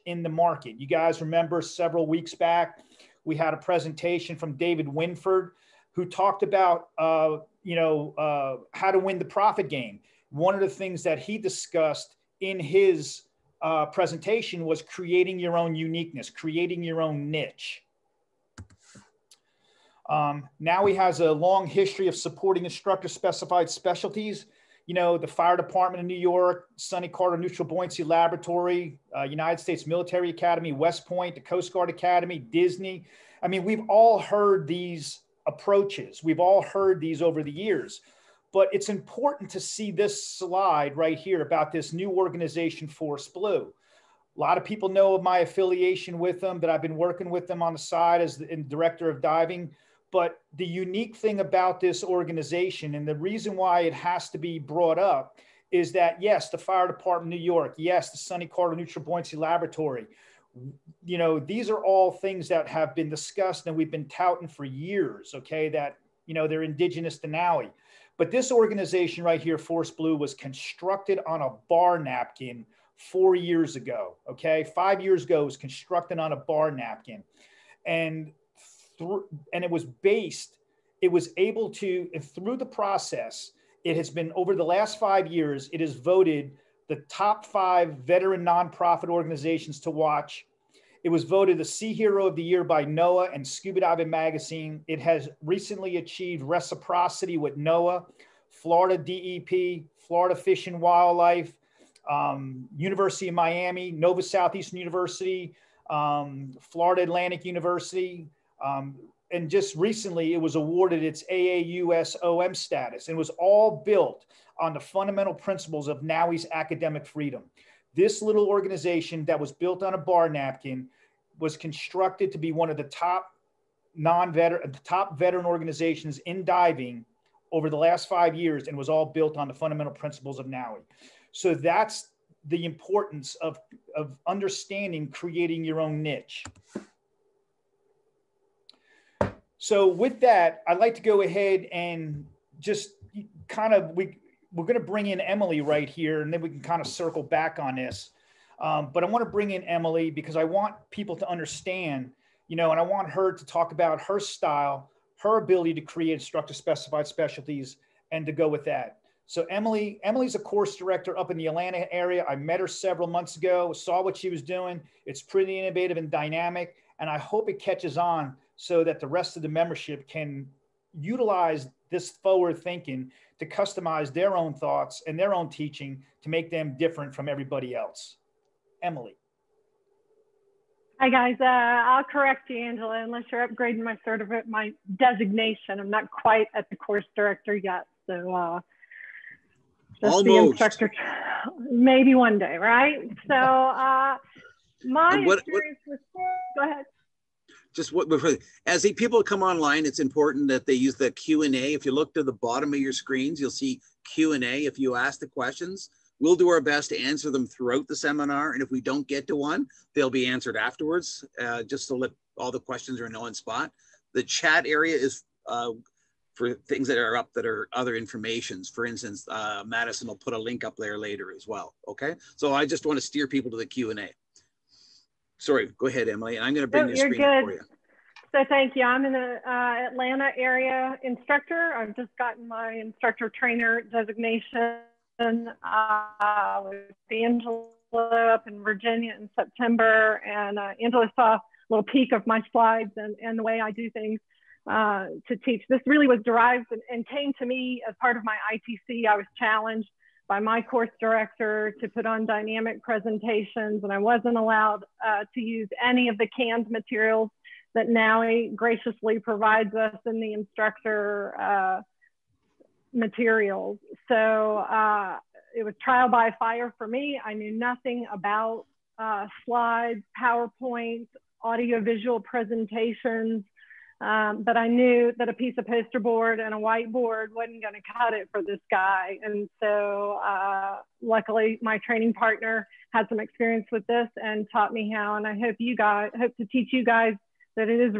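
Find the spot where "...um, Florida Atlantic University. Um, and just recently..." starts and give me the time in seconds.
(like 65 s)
105 s.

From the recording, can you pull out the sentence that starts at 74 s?
Okay, five years ago, was constructed on a bar napkin, and th- and it was based.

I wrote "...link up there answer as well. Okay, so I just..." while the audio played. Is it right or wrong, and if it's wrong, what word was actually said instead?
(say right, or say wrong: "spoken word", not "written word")
wrong: "later", not "answer".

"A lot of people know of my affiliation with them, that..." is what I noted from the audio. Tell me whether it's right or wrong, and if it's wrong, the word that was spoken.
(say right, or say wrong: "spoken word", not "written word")
right.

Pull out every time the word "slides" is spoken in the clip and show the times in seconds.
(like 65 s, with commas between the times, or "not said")
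40 s, 242 s, 269 s.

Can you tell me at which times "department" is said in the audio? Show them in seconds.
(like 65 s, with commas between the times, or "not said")
25 s, 56 s.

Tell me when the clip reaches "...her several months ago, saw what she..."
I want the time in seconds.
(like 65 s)
162 s.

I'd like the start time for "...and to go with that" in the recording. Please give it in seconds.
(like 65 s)
158 s.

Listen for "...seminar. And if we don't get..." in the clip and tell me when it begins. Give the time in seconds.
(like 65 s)
207 s.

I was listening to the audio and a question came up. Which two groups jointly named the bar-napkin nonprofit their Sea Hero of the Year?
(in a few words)
NOAA and Scuba Diving Magazine.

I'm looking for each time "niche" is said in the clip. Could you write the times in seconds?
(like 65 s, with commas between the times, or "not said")
17 s, 136 s.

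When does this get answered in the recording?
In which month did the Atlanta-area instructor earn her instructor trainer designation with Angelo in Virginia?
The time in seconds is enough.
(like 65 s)
239 s.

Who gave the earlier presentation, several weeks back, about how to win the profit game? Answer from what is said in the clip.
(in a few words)
David Winford.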